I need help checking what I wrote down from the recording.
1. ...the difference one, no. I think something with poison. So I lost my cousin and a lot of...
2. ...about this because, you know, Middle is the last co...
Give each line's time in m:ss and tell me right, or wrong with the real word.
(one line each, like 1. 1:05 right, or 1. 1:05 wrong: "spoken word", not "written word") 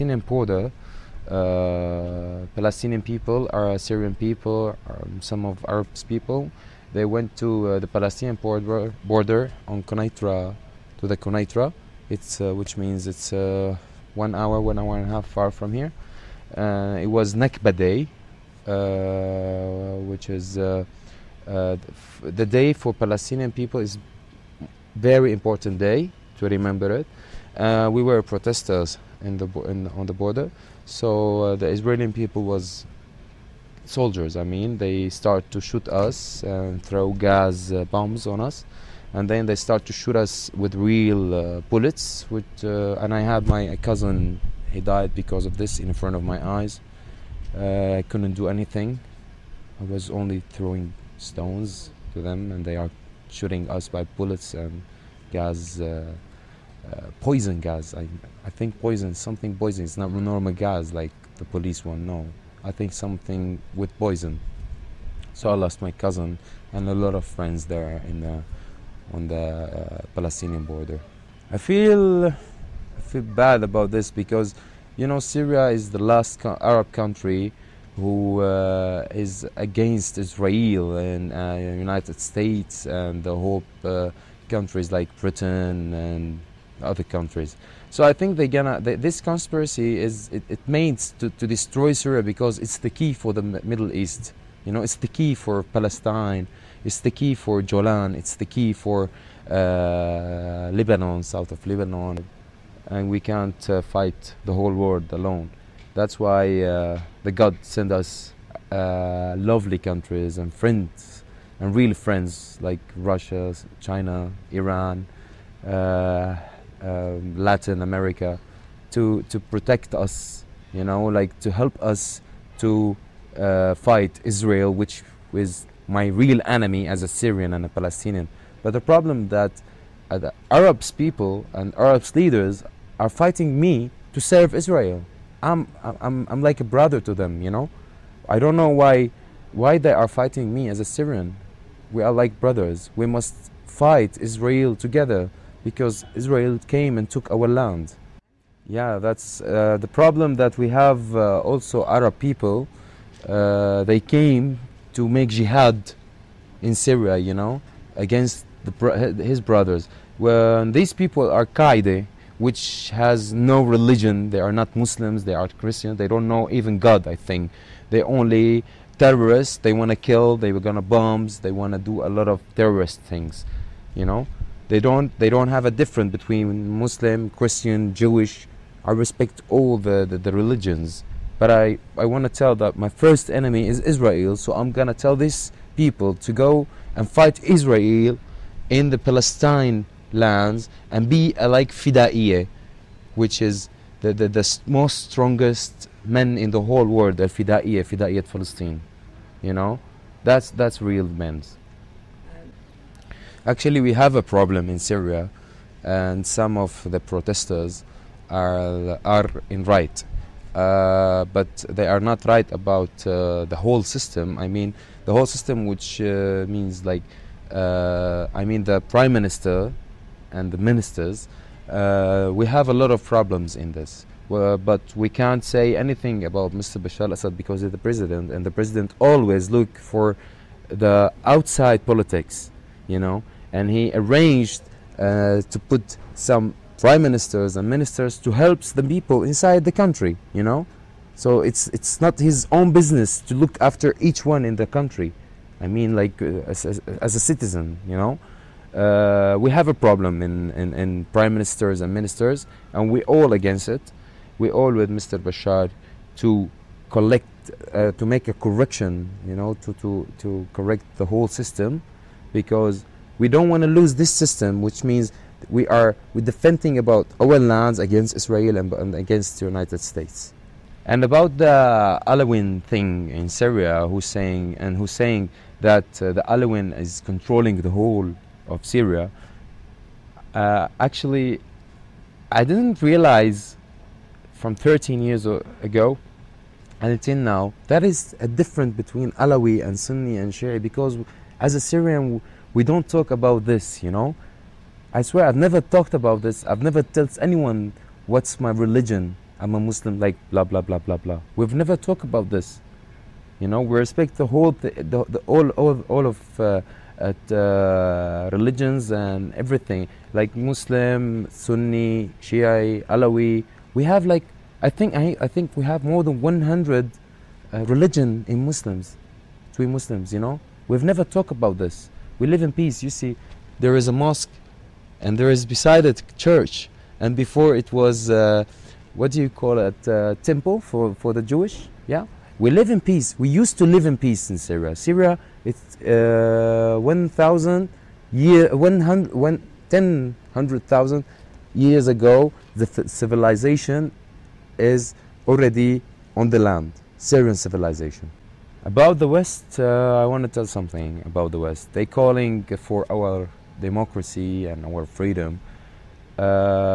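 1. 1:01 wrong: "police", not "difference"
2. 1:13 wrong: "Syria", not "Middle".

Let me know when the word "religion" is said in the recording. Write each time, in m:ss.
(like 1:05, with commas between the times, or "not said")
2:43, 3:00, 4:58, 5:08, 5:17.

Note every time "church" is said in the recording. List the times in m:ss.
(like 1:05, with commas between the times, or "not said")
5:26.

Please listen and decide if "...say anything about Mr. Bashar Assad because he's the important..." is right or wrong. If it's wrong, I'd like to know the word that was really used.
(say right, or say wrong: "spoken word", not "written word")
wrong: "president", not "important".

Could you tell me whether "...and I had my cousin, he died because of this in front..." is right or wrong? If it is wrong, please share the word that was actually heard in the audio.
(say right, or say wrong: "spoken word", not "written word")
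right.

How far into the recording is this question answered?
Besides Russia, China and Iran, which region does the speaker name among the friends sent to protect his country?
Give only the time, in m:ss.
1:57.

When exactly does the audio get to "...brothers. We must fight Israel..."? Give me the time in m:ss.
2:22.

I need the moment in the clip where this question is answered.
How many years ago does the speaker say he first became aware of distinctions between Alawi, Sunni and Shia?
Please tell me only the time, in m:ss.
4:44.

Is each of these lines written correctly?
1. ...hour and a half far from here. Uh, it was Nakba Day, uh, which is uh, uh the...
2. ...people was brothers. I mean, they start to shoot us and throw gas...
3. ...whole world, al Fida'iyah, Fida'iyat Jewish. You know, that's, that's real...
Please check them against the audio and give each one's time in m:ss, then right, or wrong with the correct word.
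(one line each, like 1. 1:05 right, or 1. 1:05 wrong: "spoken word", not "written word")
1. 0:14 right
2. 0:32 wrong: "soldiers", not "brothers"
3. 3:16 wrong: "Palestine", not "Jewish".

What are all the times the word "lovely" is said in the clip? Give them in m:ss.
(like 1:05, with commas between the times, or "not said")
1:49.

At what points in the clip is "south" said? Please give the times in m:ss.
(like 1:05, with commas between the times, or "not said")
1:41.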